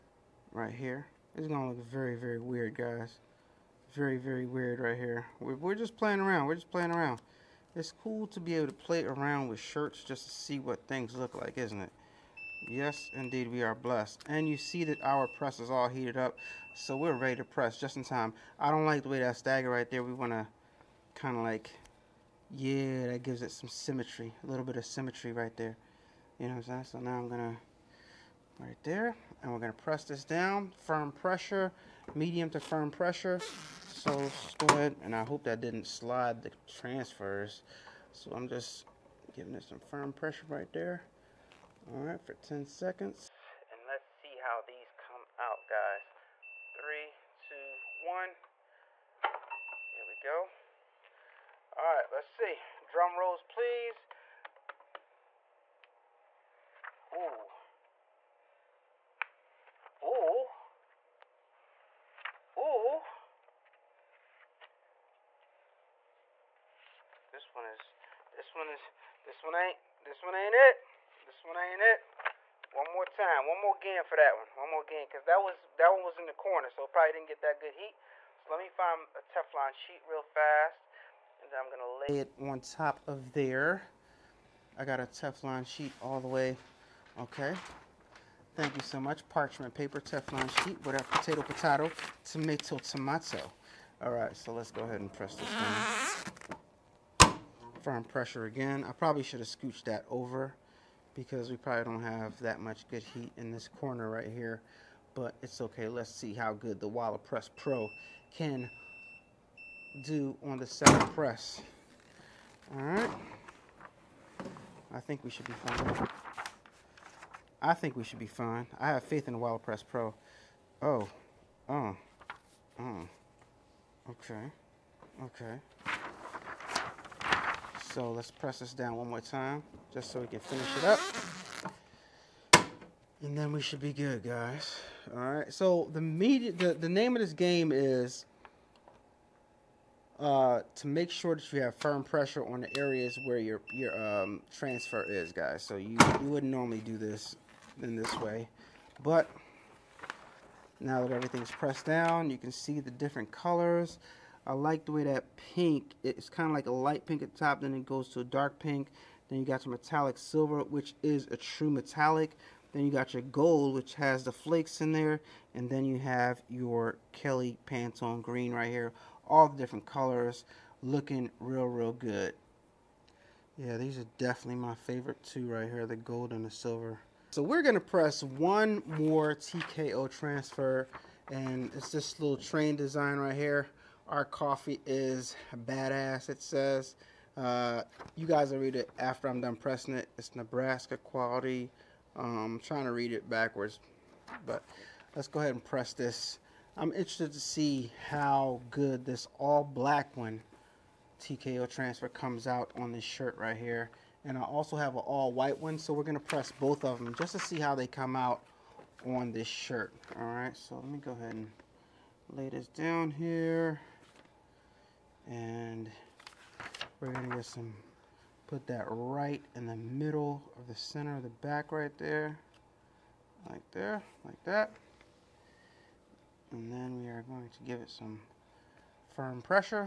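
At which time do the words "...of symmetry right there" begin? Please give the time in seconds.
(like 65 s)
24 s.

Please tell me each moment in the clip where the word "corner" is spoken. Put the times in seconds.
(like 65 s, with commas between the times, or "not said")
76 s, 103 s.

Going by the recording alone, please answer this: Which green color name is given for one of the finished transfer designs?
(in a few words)
Kelly Pantone green.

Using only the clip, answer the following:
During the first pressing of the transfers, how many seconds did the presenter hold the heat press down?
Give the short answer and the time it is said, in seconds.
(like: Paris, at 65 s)
10 seconds, at 42 s.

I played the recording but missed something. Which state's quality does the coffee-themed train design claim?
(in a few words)
Nebraska.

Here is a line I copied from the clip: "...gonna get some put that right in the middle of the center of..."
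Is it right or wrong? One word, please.
right.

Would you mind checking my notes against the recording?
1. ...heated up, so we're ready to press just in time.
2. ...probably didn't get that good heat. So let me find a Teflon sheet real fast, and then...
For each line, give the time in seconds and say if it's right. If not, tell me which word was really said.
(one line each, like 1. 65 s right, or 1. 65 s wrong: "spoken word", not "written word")
1. 15 s right
2. 76 s right.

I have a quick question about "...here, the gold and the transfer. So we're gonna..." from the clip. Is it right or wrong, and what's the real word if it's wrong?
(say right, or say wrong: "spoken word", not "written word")
wrong: "silver", not "transfer".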